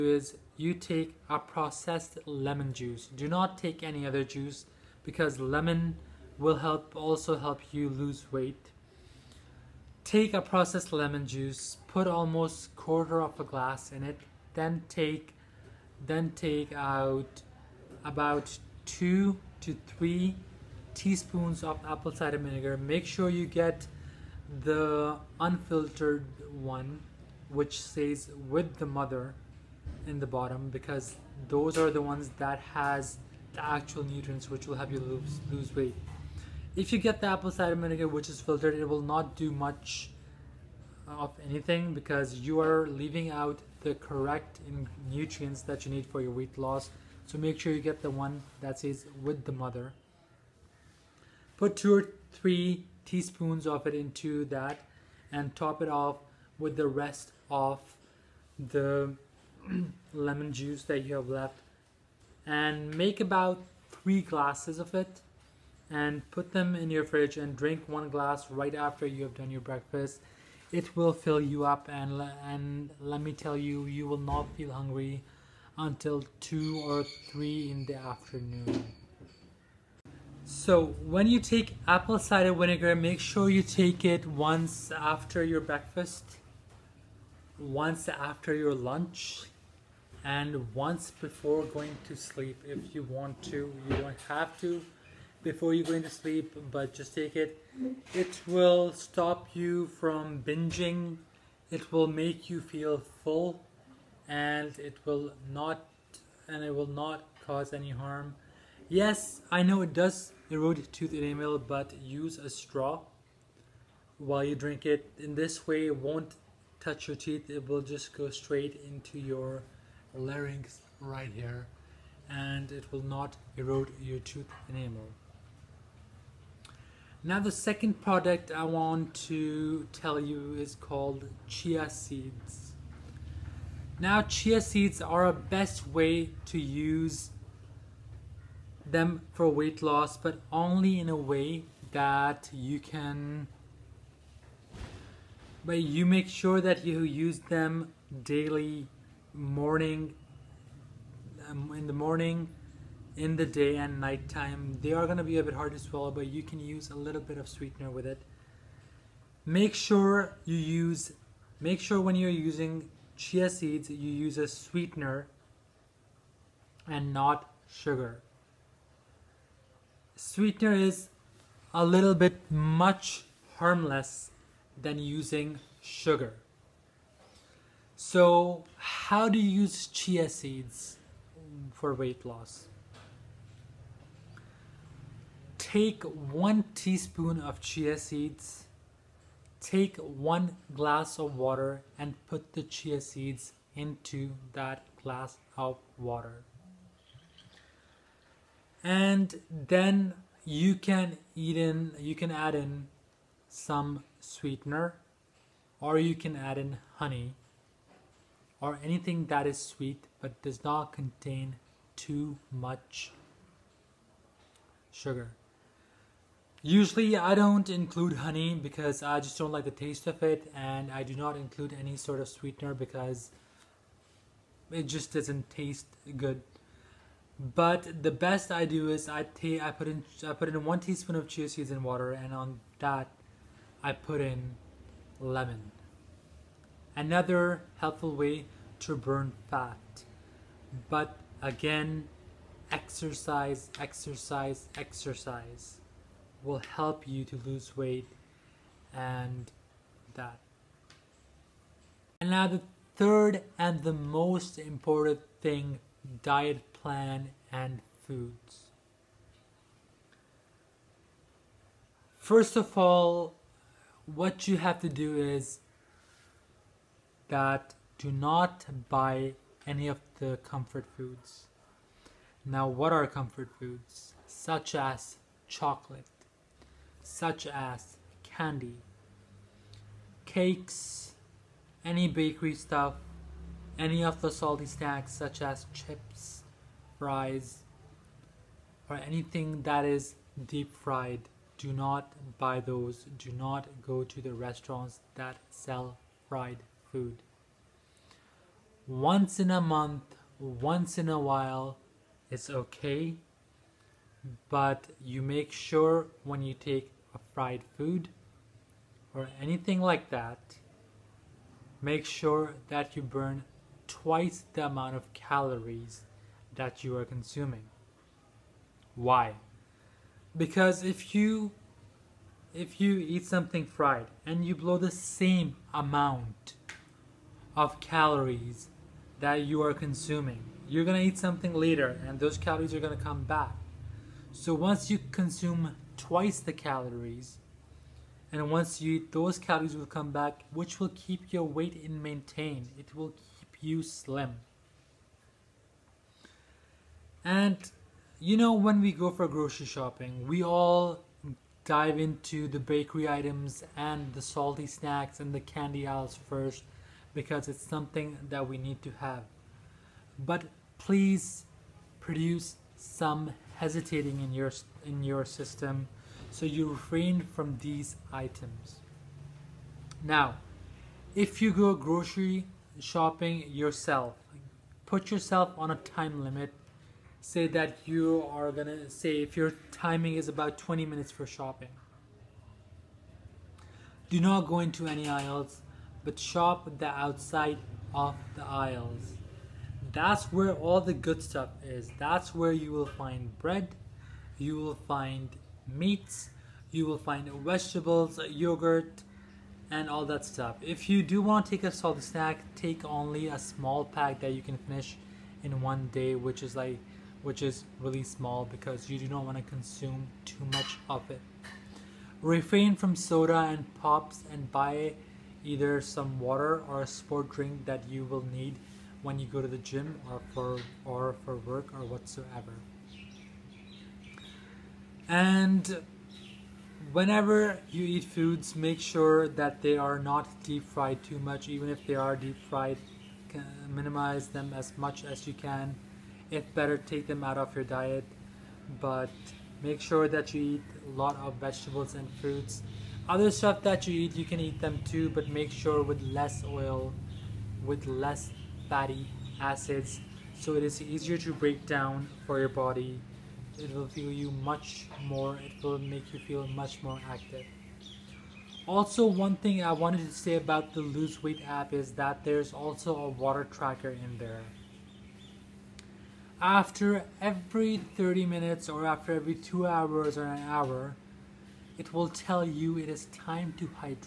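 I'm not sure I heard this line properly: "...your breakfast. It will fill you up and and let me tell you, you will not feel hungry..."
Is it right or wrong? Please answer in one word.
right.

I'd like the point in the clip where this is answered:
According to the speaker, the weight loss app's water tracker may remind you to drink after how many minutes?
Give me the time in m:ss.
7:47.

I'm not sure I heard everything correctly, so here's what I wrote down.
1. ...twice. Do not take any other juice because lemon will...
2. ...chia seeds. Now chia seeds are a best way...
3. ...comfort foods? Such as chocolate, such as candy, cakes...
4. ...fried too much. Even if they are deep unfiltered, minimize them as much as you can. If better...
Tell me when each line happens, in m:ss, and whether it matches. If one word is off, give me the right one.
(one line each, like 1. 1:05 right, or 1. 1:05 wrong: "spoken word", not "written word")
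1. 0:02 wrong: "juice", not "twice"
2. 2:11 right
3. 4:33 right
4. 7:10 wrong: "fried", not "unfiltered".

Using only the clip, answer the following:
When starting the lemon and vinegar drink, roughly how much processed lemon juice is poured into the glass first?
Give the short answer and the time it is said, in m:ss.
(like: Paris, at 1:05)
Quarter of a glass, at 0:12.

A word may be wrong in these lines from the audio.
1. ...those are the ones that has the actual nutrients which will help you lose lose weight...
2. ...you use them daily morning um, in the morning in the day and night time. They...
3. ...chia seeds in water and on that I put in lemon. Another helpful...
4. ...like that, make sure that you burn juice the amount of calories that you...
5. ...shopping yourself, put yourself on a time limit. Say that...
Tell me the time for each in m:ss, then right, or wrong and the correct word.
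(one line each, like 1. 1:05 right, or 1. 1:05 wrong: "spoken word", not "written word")
1. 0:31 right
2. 2:26 right
3. 3:51 right
4. 5:09 wrong: "twice", not "juice"
5. 6:12 right.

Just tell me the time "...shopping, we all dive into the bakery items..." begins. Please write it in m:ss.
5:49.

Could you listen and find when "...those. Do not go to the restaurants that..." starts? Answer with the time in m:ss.
4:52.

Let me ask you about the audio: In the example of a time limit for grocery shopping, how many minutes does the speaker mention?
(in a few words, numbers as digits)
20 minutes.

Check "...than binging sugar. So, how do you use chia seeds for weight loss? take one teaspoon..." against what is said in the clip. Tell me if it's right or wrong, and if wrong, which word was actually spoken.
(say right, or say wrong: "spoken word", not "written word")
wrong: "using", not "binging".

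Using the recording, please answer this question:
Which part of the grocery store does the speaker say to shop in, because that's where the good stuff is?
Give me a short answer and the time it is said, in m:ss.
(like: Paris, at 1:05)
The outside of the aisles, at 6:26.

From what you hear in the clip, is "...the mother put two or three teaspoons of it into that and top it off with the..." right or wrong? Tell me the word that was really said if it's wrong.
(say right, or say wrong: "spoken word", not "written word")
right.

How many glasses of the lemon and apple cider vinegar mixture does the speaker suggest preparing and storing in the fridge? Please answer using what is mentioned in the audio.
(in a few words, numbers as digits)
3 glasses.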